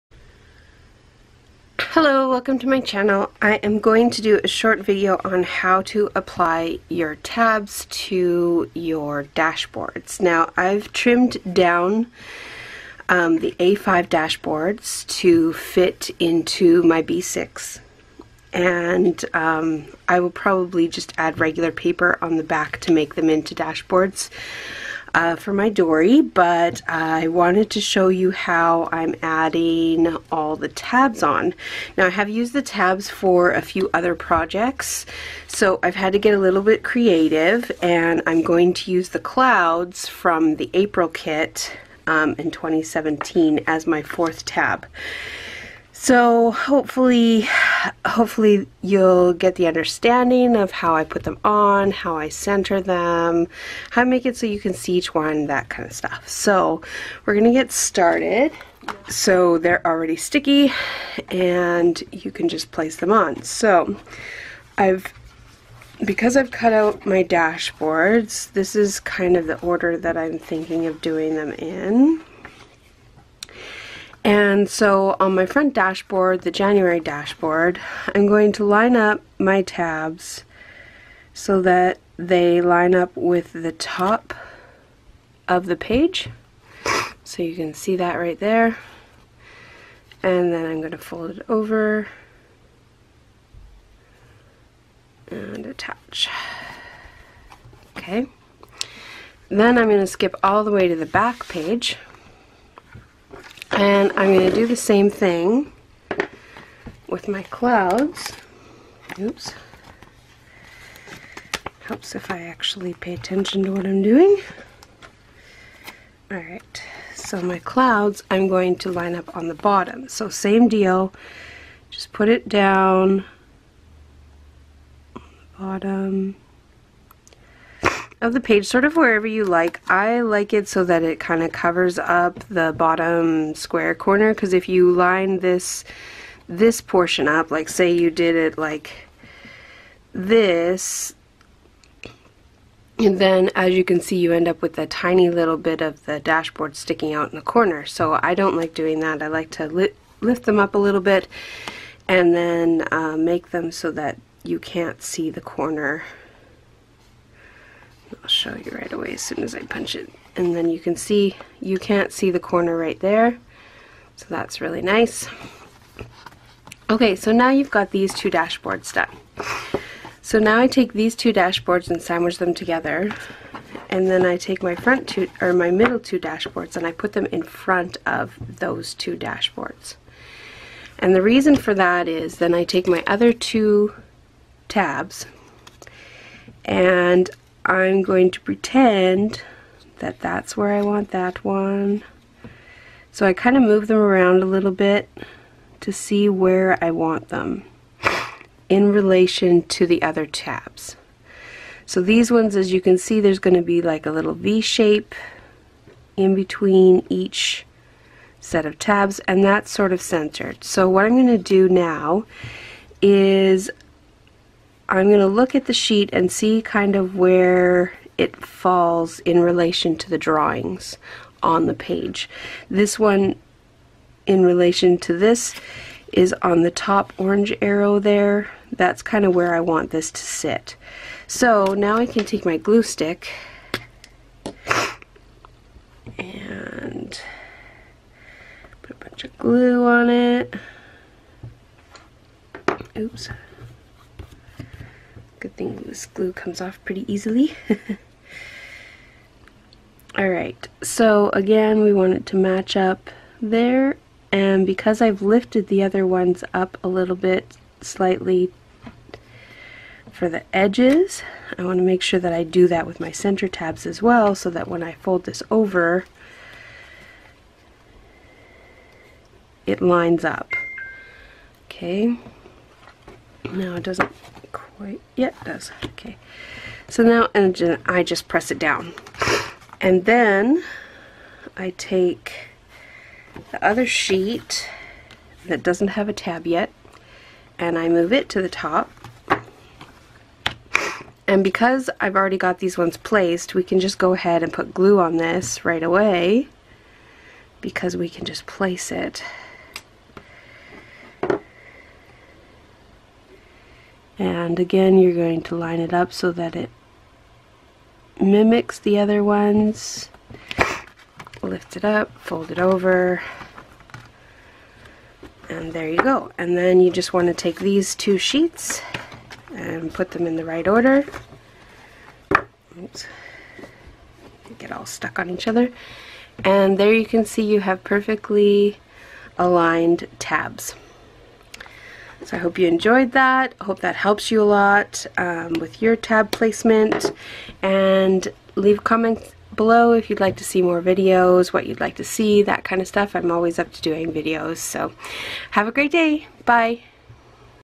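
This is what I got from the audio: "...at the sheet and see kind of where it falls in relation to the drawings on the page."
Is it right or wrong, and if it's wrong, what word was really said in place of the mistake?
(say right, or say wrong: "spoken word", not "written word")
right.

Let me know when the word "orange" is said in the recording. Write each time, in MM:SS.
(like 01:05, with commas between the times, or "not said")
03:47.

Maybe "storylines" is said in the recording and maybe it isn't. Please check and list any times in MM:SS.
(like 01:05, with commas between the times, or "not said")
not said.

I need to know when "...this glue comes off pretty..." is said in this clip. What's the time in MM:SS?
04:05.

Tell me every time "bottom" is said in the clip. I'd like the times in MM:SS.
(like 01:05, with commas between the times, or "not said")
01:59, 02:05, 02:12.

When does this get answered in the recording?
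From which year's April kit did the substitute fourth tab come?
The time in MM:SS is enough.
00:42.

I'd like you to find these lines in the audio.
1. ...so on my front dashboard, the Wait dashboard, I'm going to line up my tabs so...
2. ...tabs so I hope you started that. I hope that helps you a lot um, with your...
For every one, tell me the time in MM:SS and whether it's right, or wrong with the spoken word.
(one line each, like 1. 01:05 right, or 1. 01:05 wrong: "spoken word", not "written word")
1. 01:14 wrong: "January", not "Wait"
2. 05:30 wrong: "enjoyed", not "started".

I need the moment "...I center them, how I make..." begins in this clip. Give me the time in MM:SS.
00:52.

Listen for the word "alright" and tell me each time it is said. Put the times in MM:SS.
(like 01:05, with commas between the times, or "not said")
01:56, 04:10.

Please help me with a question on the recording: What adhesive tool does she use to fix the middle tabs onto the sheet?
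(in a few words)
glue stick.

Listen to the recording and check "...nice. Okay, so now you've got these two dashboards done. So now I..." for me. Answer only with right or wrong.
right.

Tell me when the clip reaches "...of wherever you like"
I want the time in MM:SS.
02:08.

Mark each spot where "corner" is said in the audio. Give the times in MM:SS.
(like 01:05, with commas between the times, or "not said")
02:13, 02:27, 02:35, 02:42.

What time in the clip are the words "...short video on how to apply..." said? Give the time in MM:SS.
00:04.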